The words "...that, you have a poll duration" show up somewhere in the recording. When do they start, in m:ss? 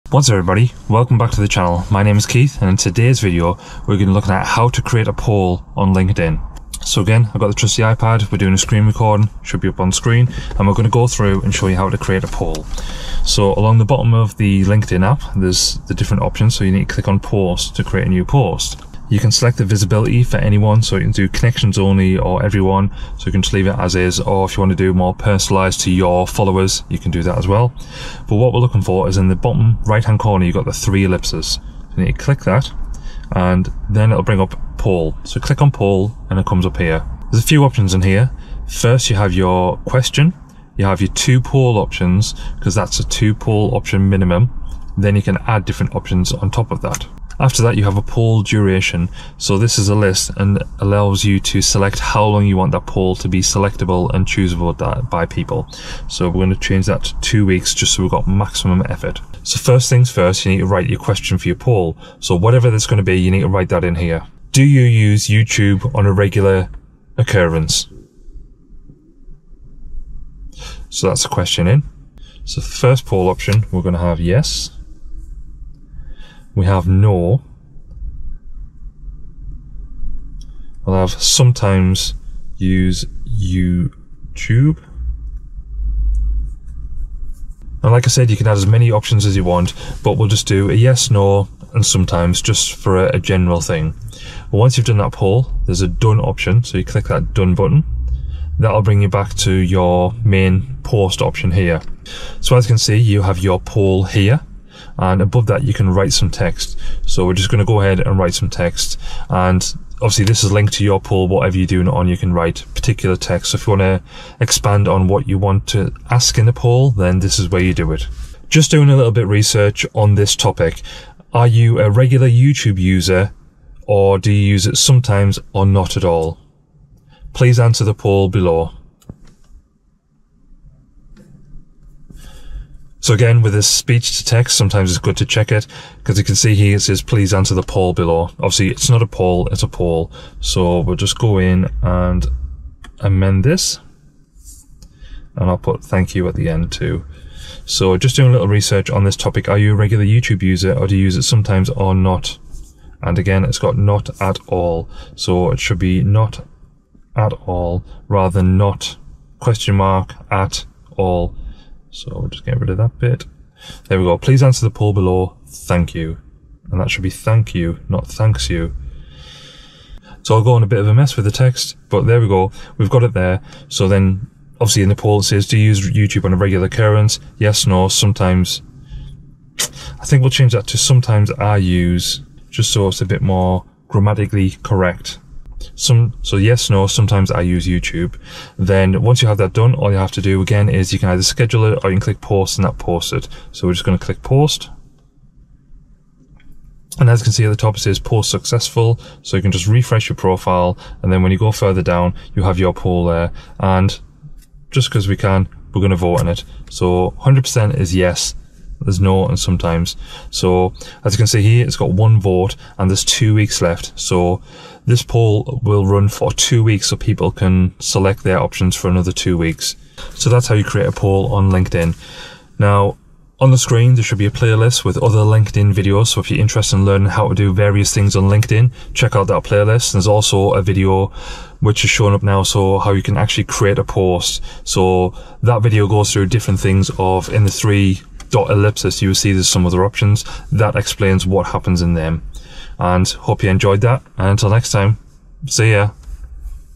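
0:47.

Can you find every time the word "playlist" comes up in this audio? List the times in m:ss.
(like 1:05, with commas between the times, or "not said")
3:44, 3:49.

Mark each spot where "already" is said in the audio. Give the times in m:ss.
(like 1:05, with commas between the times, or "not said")
not said.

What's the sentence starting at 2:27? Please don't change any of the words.
So just doing a little research on this topic.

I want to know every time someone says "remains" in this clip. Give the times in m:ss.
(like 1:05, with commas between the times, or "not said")
not said.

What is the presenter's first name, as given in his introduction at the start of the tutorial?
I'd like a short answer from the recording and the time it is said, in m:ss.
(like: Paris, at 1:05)
Keith, at 0:02.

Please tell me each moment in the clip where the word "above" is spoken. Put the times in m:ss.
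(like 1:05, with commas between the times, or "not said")
1:45.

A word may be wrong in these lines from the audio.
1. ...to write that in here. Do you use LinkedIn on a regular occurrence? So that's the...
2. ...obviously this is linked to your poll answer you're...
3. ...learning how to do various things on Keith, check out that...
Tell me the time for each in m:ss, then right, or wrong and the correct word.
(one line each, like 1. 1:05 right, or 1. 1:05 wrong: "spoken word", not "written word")
1. 1:03 wrong: "YouTube", not "LinkedIn"
2. 1:49 wrong: "whatever", not "answer"
3. 3:46 wrong: "LinkedIn", not "Keith".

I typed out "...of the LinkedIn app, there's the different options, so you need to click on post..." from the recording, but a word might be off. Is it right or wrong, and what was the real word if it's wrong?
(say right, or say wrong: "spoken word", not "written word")
right.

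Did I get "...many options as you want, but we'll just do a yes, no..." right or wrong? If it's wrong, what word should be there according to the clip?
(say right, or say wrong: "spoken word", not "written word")
right.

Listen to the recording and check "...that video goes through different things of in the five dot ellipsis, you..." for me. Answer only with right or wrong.
wrong.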